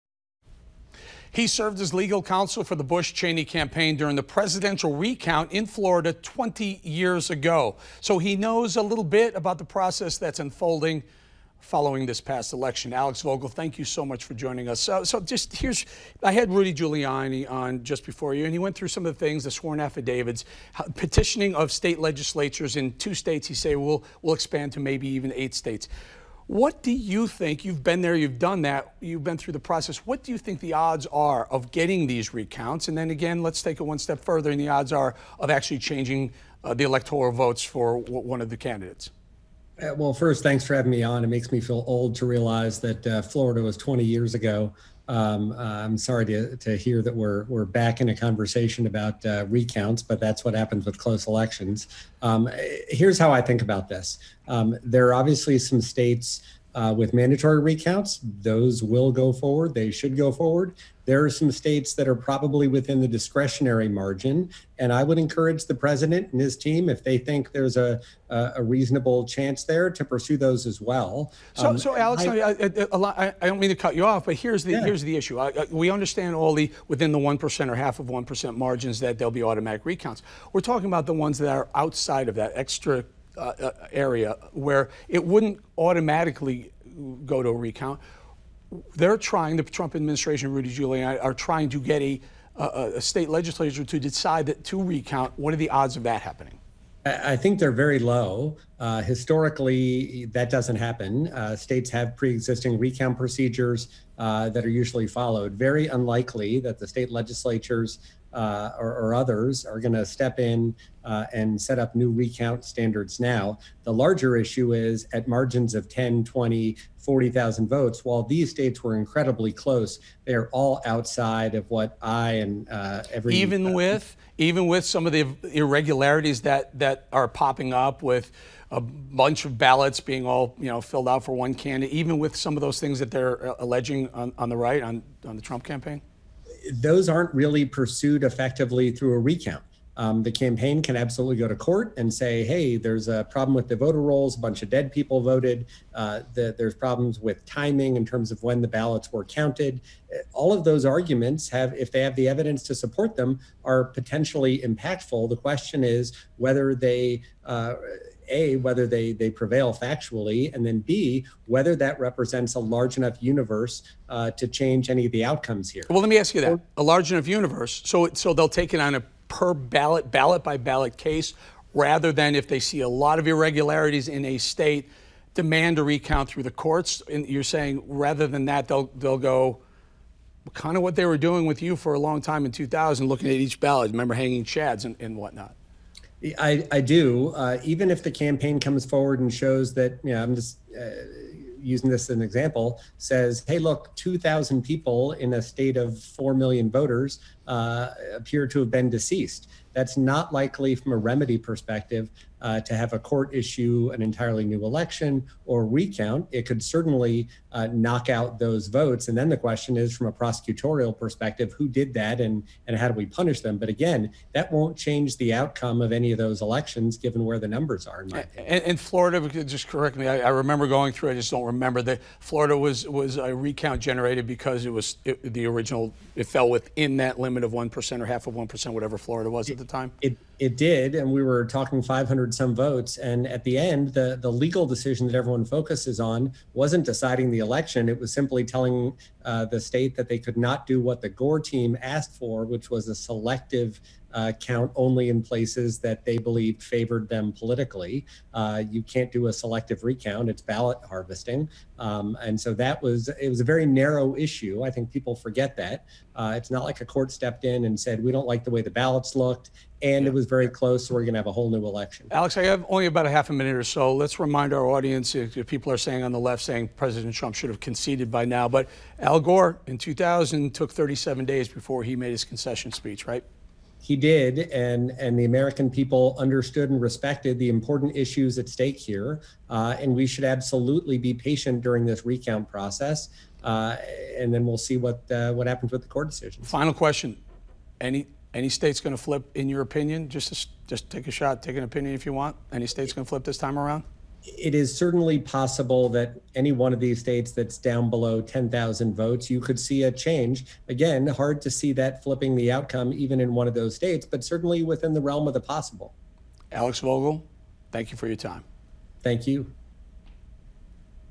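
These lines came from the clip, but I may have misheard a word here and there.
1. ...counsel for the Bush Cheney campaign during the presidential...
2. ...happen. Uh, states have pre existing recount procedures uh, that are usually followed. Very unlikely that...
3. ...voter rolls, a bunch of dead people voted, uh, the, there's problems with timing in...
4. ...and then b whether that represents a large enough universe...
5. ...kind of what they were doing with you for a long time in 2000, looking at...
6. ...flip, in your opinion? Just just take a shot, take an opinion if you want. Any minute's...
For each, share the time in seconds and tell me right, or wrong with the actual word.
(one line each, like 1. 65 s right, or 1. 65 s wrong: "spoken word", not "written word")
1. 2 s right
2. 100 s right
3. 143 s right
4. 160 s right
5. 180 s right
6. 289 s wrong: "state", not "minute".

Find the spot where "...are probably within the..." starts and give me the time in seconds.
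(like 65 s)
62 s.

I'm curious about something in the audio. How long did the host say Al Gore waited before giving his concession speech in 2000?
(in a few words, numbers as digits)
37 days.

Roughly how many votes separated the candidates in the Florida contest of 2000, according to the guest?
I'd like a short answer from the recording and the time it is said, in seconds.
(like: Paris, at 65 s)
500, at 231 s.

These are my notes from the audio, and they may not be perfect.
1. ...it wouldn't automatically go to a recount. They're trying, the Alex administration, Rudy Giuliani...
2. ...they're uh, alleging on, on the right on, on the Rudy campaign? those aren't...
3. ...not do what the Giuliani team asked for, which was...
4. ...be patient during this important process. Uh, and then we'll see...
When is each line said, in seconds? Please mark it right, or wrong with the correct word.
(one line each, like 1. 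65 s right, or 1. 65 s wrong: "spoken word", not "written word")
1. 85 s wrong: "Trump", not "Alex"
2. 133 s wrong: "Trump", not "Rudy"
3. 240 s wrong: "Gore", not "Giuliani"
4. 280 s wrong: "recount", not "important".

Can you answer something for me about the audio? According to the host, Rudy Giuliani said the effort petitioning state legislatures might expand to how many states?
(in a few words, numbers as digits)
8.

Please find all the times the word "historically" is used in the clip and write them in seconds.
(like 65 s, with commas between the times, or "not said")
99 s.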